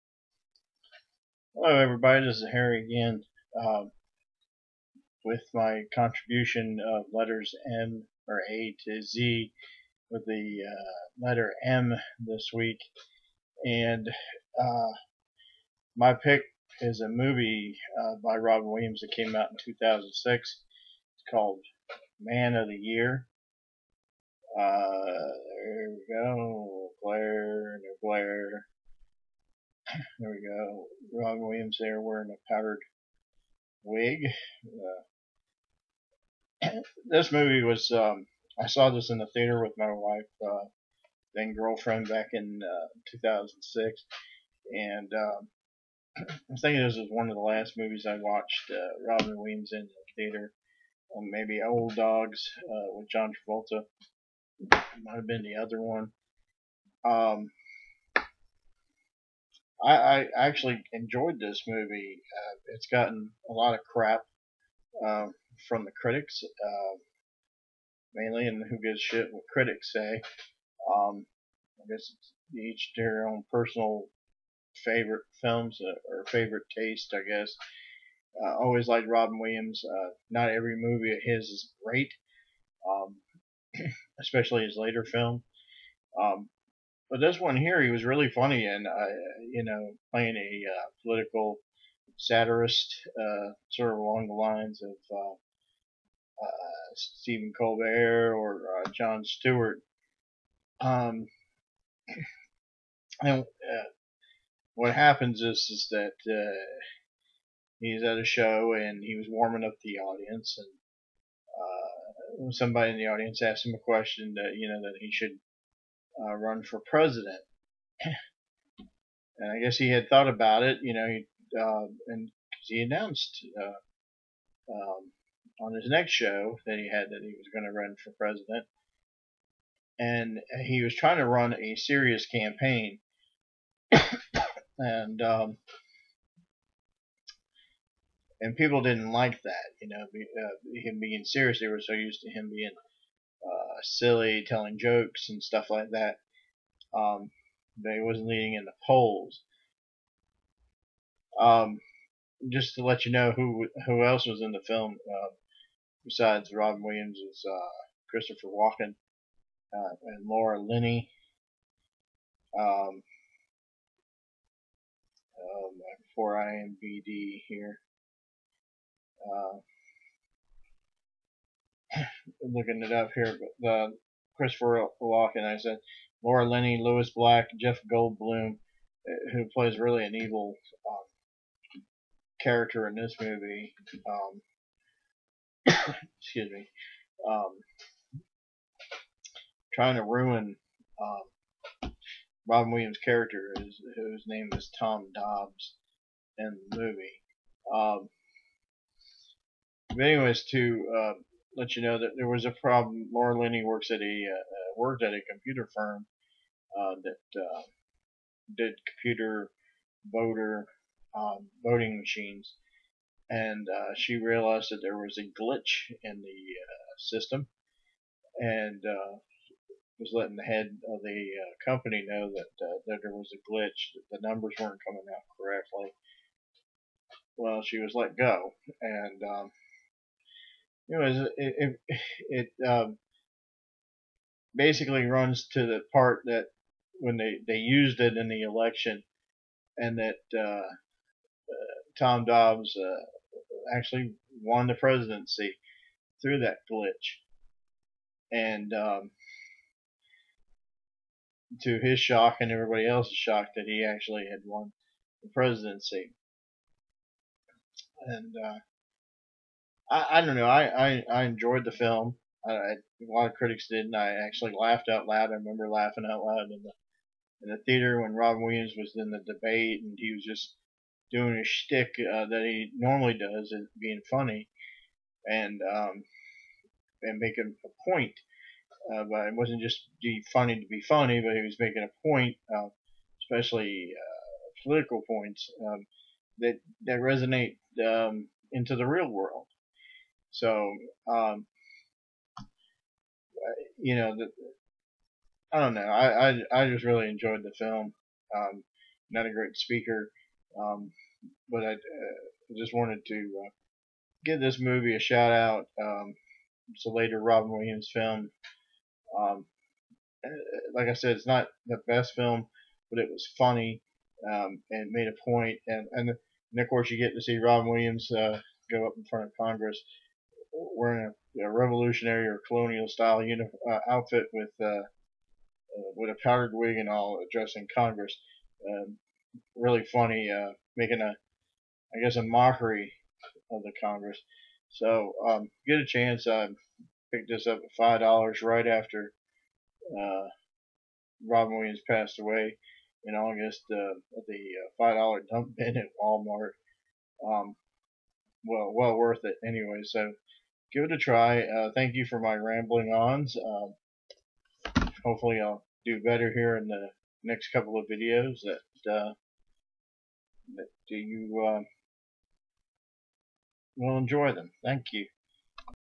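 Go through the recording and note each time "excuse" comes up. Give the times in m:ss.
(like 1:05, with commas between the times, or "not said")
3:06.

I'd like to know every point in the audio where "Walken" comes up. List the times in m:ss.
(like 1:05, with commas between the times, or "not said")
2:38, 2:55.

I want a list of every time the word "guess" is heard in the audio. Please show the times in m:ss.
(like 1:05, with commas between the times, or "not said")
1:11, 1:17, 1:59, 5:32.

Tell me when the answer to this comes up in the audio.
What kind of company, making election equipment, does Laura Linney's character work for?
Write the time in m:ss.
3:25.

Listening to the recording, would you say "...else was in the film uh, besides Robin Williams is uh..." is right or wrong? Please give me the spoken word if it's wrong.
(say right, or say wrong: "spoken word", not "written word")
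right.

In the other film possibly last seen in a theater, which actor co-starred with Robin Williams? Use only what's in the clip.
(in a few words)
John Travolta.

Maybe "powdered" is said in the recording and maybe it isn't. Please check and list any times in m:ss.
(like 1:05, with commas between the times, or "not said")
0:32, 5:26.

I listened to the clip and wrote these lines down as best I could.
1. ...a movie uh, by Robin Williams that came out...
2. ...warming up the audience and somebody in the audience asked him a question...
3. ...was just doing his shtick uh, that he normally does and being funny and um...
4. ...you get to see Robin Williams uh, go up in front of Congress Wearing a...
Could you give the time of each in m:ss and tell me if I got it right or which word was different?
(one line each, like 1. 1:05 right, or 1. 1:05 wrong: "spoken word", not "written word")
1. 0:17 right
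2. 1:49 right
3. 4:30 right
4. 5:16 right.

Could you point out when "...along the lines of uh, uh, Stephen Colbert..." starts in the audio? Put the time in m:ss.
1:33.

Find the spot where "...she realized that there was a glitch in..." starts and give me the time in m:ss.
3:33.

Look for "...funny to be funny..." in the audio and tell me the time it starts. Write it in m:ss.
4:40.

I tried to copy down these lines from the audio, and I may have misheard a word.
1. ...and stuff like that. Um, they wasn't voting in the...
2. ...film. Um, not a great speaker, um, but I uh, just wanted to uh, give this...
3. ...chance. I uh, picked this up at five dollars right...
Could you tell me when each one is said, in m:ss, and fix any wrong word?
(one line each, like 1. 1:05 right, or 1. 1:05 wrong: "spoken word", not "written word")
1. 2:25 wrong: "leading", not "voting"
2. 4:57 right
3. 5:35 right.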